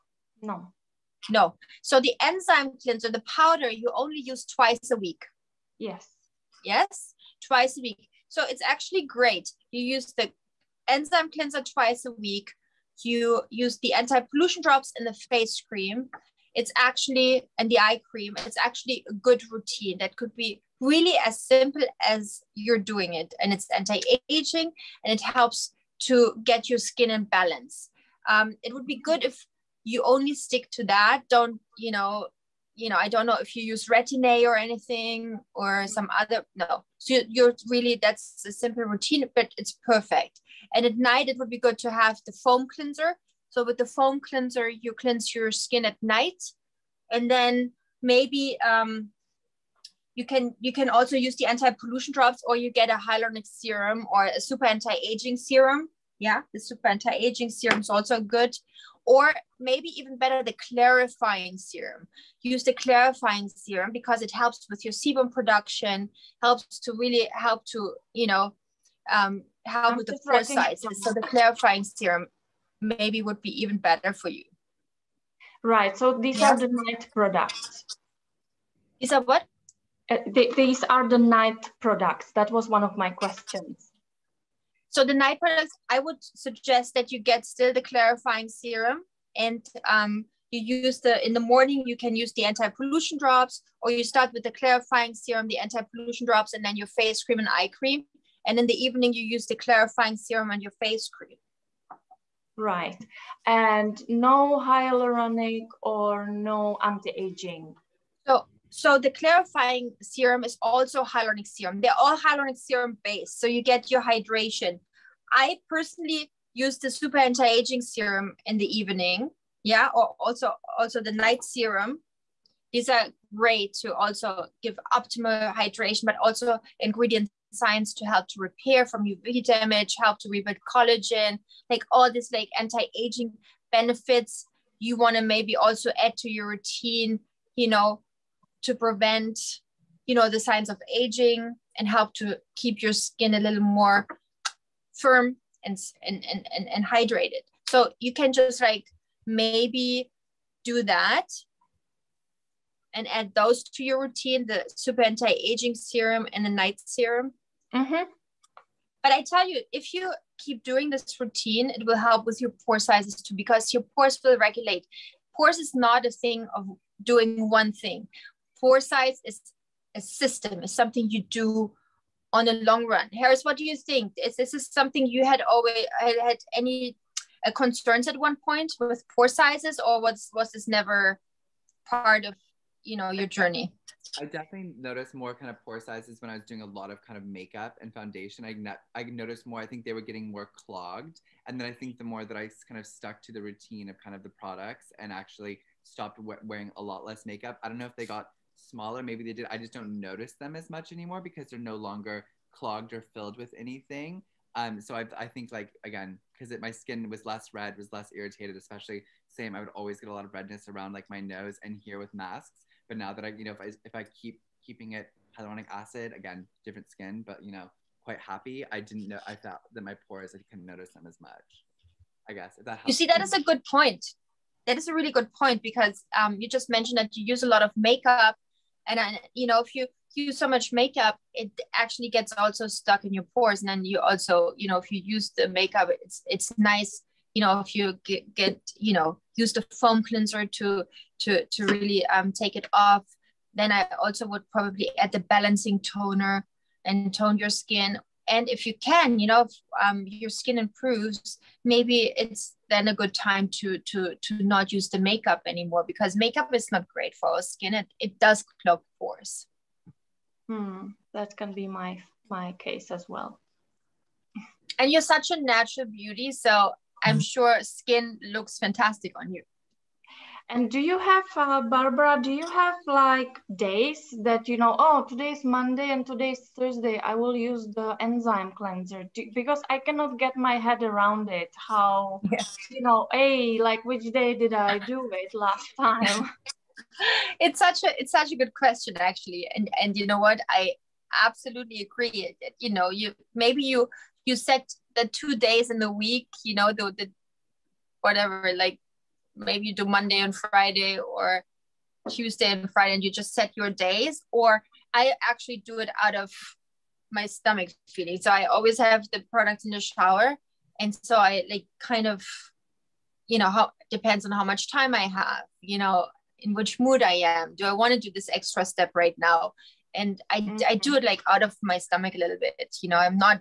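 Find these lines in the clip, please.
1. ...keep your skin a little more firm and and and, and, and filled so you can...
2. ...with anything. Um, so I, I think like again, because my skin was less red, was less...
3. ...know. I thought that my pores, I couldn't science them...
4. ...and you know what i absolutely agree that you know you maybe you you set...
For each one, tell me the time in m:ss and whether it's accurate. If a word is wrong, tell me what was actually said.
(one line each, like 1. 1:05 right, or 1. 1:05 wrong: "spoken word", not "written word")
1. 2:22 wrong: "hydrated", not "filled"
2. 3:23 right
3. 3:39 wrong: "notice", not "science"
4. 4:49 right.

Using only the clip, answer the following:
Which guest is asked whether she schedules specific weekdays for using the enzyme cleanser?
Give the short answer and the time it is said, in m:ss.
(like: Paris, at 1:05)
Barbara, at 4:31.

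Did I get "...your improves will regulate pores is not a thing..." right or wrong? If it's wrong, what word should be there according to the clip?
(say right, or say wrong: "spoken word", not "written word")
wrong: "pores", not "improves".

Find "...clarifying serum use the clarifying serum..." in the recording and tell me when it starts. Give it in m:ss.
1:00.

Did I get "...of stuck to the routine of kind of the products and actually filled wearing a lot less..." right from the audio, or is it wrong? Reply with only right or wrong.
wrong.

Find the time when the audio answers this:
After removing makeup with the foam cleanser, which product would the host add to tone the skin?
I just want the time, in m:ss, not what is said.
4:05.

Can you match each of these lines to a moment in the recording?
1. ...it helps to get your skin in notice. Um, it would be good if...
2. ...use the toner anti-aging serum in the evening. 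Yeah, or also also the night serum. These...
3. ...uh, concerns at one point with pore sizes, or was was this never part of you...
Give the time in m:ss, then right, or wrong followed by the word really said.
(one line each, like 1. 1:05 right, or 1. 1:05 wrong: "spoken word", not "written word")
1. 0:25 wrong: "balance", not "notice"
2. 1:56 wrong: "super", not "toner"
3. 2:57 right.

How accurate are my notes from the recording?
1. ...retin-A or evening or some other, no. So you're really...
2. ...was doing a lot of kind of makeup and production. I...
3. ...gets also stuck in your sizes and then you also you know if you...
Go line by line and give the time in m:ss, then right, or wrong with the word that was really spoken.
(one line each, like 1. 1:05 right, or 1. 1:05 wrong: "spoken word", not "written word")
1. 0:33 wrong: "anything", not "evening"
2. 3:06 wrong: "foundation", not "production"
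3. 3:52 wrong: "pores", not "sizes".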